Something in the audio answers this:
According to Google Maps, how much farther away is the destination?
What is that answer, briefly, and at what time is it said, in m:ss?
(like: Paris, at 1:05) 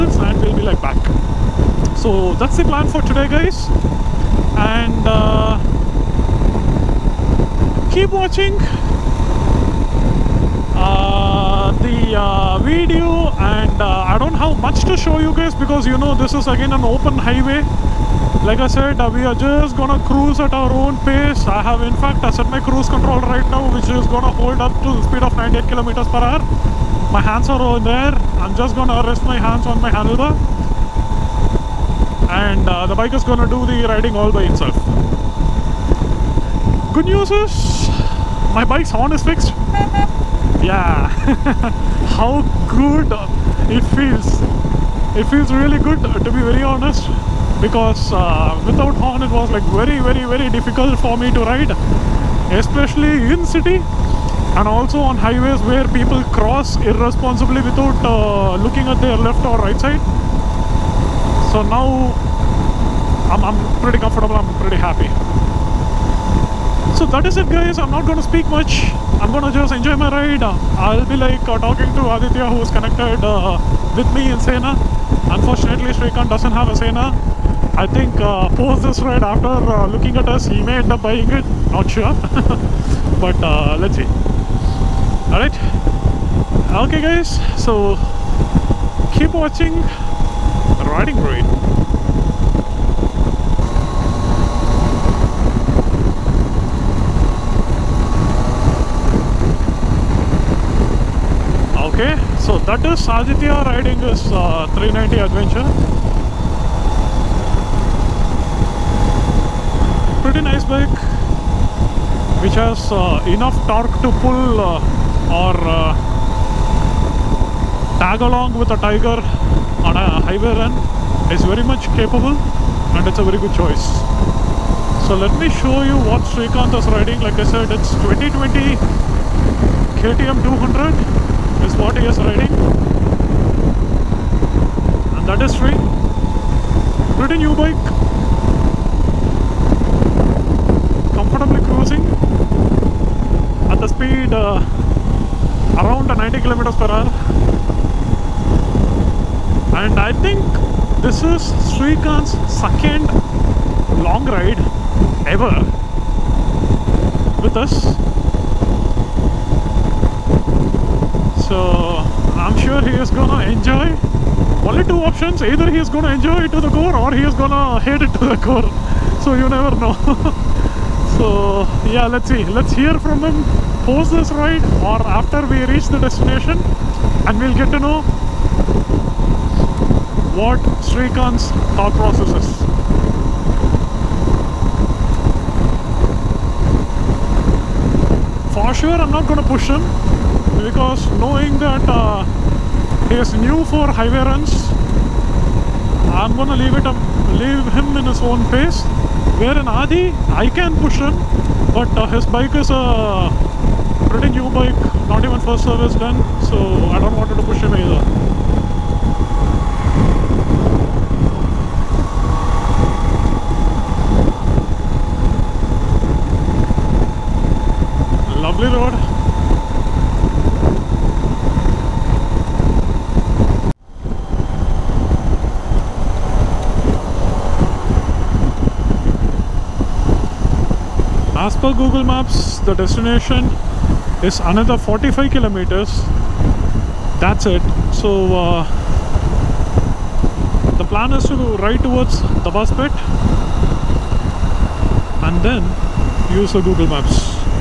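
45 kilometers, at 3:54.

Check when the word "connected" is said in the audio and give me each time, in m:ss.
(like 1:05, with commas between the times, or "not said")
1:12.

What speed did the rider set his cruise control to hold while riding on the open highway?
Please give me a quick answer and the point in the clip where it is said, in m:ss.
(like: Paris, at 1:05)
98 km/h, at 0:25.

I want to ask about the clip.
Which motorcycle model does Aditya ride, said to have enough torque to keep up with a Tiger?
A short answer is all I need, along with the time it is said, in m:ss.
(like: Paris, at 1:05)
390 Adventure, at 1:44.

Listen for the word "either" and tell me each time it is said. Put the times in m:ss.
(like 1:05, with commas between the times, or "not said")
2:45, 3:27.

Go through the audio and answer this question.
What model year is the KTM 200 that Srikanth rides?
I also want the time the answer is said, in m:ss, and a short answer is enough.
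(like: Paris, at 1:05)
2020, at 2:08.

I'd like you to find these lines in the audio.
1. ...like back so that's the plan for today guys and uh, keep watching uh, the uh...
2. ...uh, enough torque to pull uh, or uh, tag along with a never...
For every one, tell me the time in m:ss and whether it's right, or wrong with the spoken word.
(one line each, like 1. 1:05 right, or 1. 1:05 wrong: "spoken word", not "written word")
1. 0:00 right
2. 1:52 wrong: "tiger", not "never".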